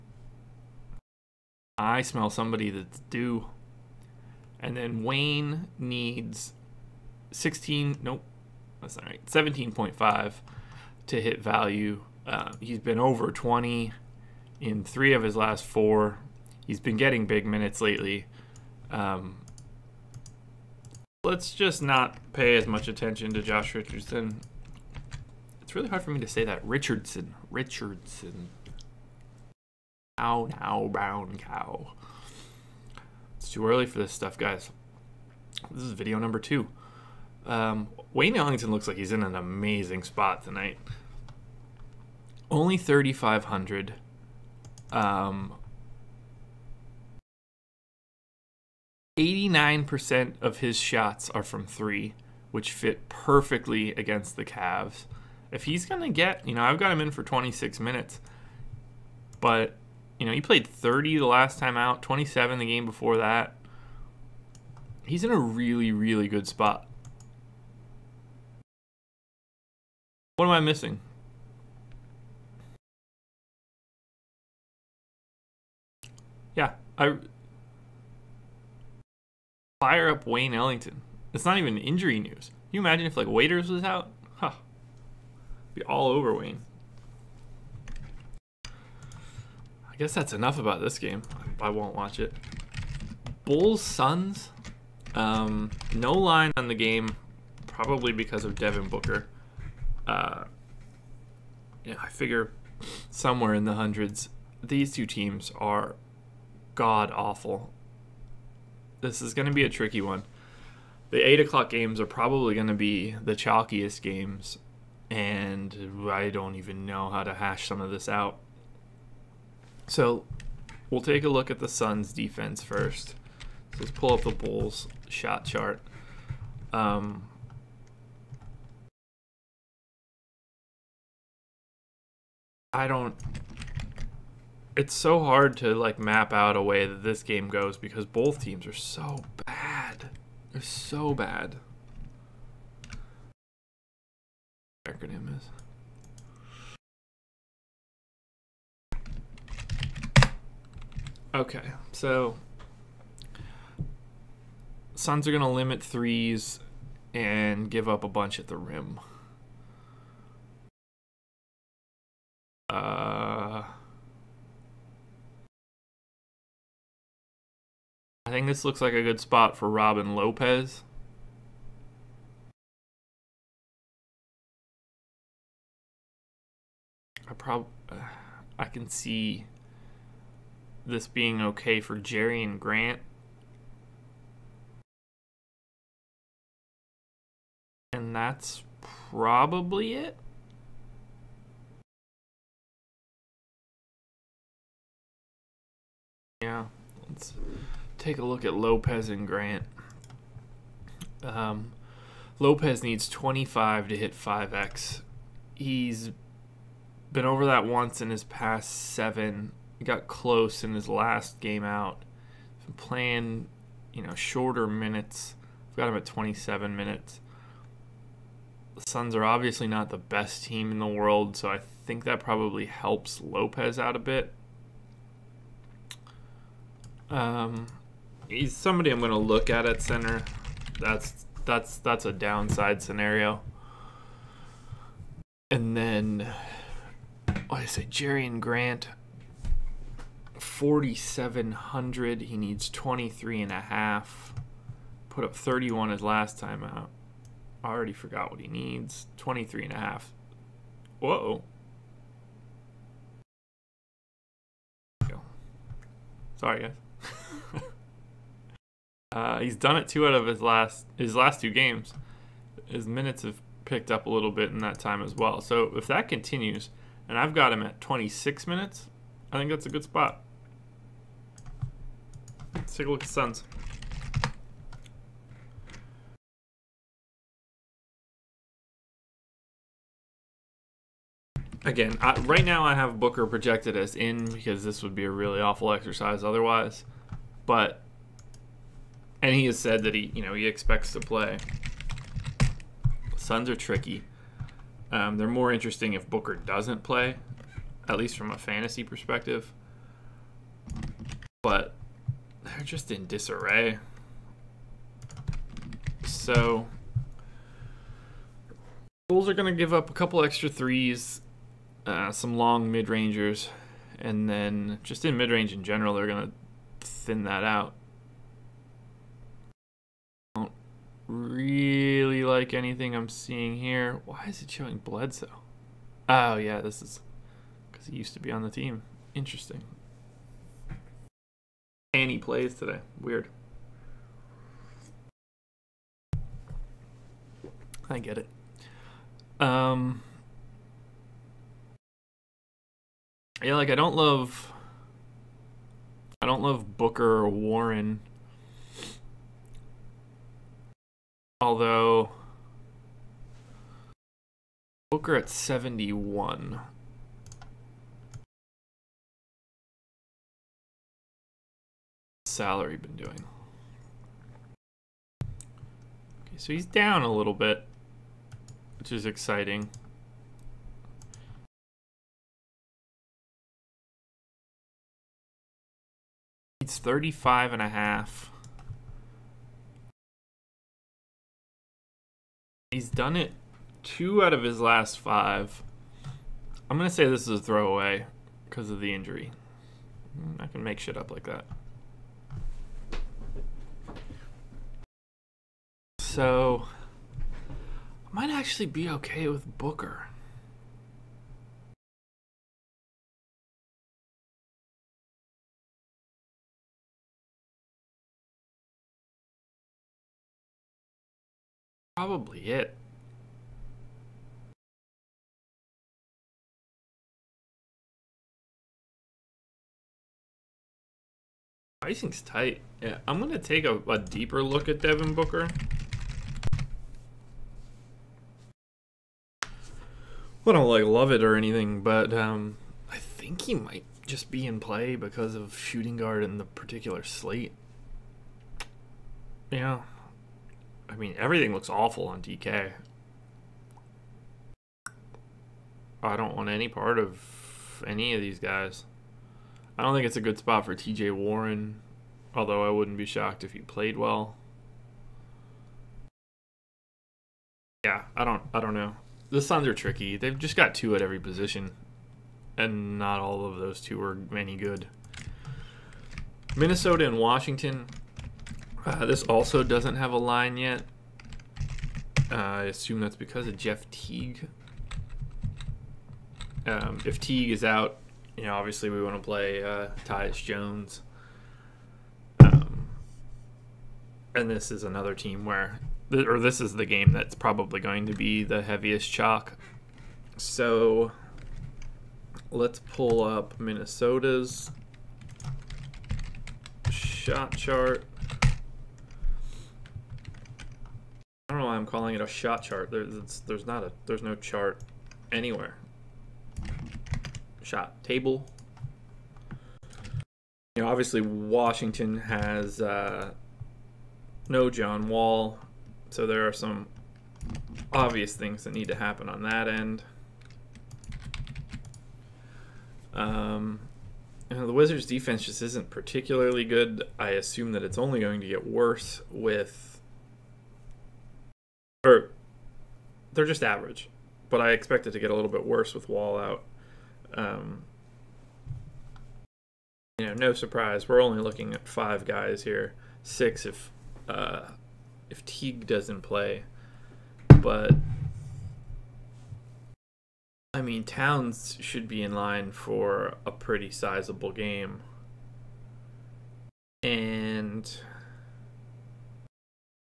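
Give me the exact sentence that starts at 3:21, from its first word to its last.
Um, Lopez needs 25 to hit 5x.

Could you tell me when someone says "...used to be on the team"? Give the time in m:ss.
5:27.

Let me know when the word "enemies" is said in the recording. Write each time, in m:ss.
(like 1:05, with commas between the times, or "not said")
not said.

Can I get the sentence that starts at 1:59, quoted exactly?
So we'll take a look at the Suns' defense first.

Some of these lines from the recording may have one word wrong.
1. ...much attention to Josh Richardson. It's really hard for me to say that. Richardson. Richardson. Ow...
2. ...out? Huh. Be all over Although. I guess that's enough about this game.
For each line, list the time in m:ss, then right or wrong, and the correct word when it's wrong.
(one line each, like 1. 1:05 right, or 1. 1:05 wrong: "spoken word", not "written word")
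1. 0:22 right
2. 1:23 wrong: "Wayne", not "Although".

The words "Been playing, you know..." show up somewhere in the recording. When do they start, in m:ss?
3:32.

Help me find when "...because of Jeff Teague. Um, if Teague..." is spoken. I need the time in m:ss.
7:53.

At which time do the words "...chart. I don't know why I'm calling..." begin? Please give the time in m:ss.
8:17.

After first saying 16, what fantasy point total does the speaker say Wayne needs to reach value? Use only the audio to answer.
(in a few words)
17.5.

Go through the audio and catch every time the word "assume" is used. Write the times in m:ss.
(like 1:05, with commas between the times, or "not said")
7:52, 8:47.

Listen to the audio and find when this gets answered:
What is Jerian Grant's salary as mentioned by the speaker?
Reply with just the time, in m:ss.
4:00.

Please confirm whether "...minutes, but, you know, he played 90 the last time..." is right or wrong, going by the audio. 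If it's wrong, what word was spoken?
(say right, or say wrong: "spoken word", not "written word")
wrong: "30", not "90".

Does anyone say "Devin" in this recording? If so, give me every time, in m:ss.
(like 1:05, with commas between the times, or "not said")
1:38, 7:04.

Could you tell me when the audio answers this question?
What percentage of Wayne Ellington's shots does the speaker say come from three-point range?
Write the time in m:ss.
0:49.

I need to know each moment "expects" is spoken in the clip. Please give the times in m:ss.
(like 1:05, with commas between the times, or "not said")
4:50, 8:54.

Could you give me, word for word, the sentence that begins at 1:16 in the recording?
Yeah, I fire up Wayne Ellington.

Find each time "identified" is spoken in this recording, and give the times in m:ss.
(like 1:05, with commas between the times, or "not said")
not said.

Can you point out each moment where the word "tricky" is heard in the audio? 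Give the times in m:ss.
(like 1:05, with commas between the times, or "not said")
1:49, 4:53, 7:39.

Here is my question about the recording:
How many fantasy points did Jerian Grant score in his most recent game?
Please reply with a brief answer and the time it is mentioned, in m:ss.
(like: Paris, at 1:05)
31, at 4:05.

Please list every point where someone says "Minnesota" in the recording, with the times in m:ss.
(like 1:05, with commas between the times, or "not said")
7:46, 8:13.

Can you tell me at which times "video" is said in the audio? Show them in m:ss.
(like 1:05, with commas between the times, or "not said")
0:35.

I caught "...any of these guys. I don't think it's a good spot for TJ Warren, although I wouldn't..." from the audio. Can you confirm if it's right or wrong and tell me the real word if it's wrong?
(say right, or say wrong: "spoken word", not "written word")
right.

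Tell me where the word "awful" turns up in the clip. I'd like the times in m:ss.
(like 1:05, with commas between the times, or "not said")
1:47, 4:45, 7:21.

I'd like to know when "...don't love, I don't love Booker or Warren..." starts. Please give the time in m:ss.
5:43.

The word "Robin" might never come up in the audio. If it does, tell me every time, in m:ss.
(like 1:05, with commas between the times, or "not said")
2:49.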